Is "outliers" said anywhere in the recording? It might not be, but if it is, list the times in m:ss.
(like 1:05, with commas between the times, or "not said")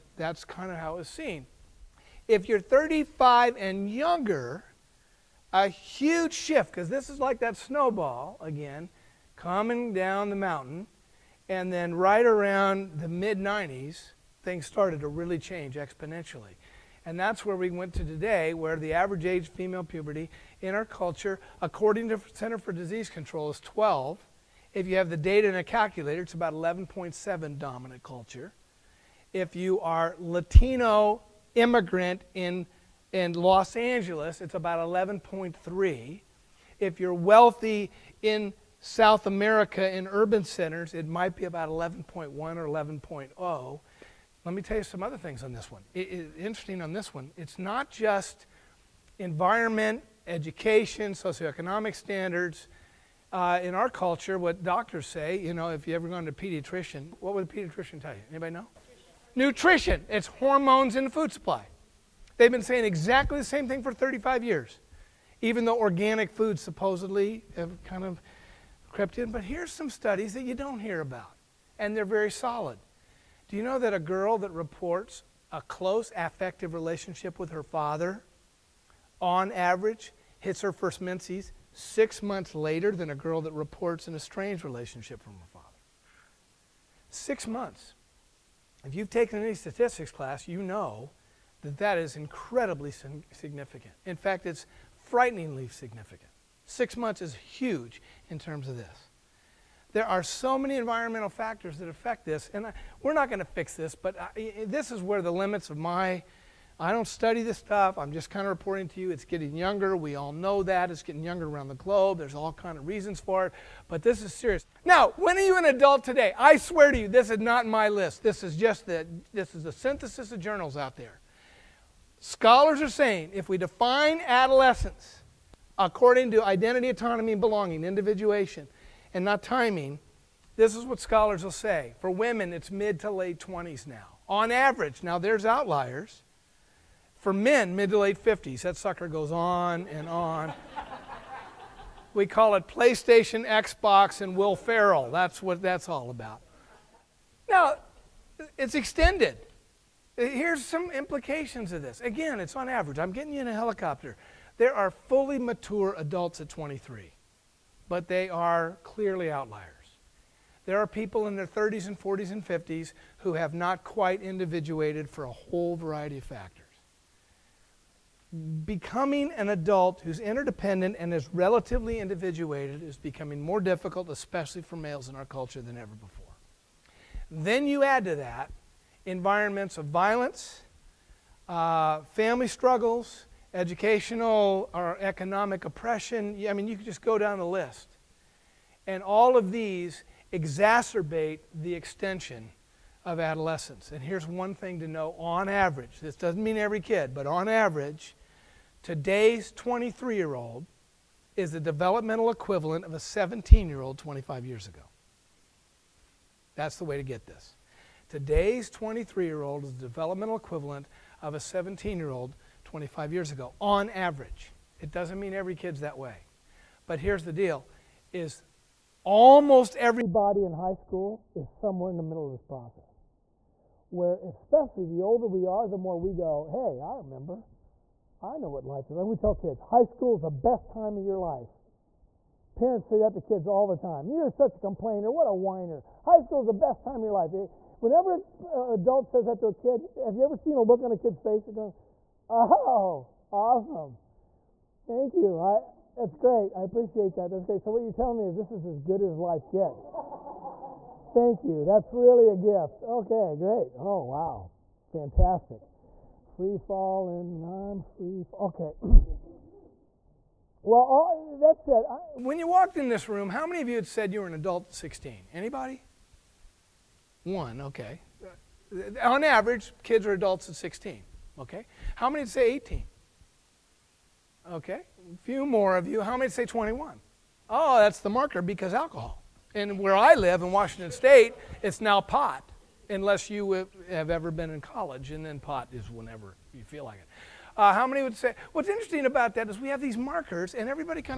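2:15, 2:39.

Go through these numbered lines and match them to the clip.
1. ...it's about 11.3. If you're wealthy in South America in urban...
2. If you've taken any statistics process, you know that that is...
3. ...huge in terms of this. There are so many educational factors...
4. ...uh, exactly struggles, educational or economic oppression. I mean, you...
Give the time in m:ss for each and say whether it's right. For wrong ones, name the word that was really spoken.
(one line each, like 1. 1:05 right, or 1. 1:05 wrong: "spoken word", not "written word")
1. 0:34 right
2. 1:28 wrong: "class", not "process"
3. 1:37 wrong: "environmental", not "educational"
4. 3:01 wrong: "family", not "exactly".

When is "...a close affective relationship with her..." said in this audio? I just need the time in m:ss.
1:15.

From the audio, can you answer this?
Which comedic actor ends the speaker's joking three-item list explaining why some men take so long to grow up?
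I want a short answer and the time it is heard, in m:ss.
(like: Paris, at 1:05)
Will Ferrell, at 2:24.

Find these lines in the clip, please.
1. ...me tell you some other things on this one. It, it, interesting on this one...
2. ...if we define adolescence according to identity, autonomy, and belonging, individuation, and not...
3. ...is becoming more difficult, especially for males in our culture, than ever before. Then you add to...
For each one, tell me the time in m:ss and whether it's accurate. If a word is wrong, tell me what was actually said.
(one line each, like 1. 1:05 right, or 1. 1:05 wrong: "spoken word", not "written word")
1. 0:44 right
2. 2:03 right
3. 2:52 right.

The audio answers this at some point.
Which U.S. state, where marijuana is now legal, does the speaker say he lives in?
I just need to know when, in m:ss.
4:40.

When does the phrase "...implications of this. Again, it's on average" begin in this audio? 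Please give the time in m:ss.
2:30.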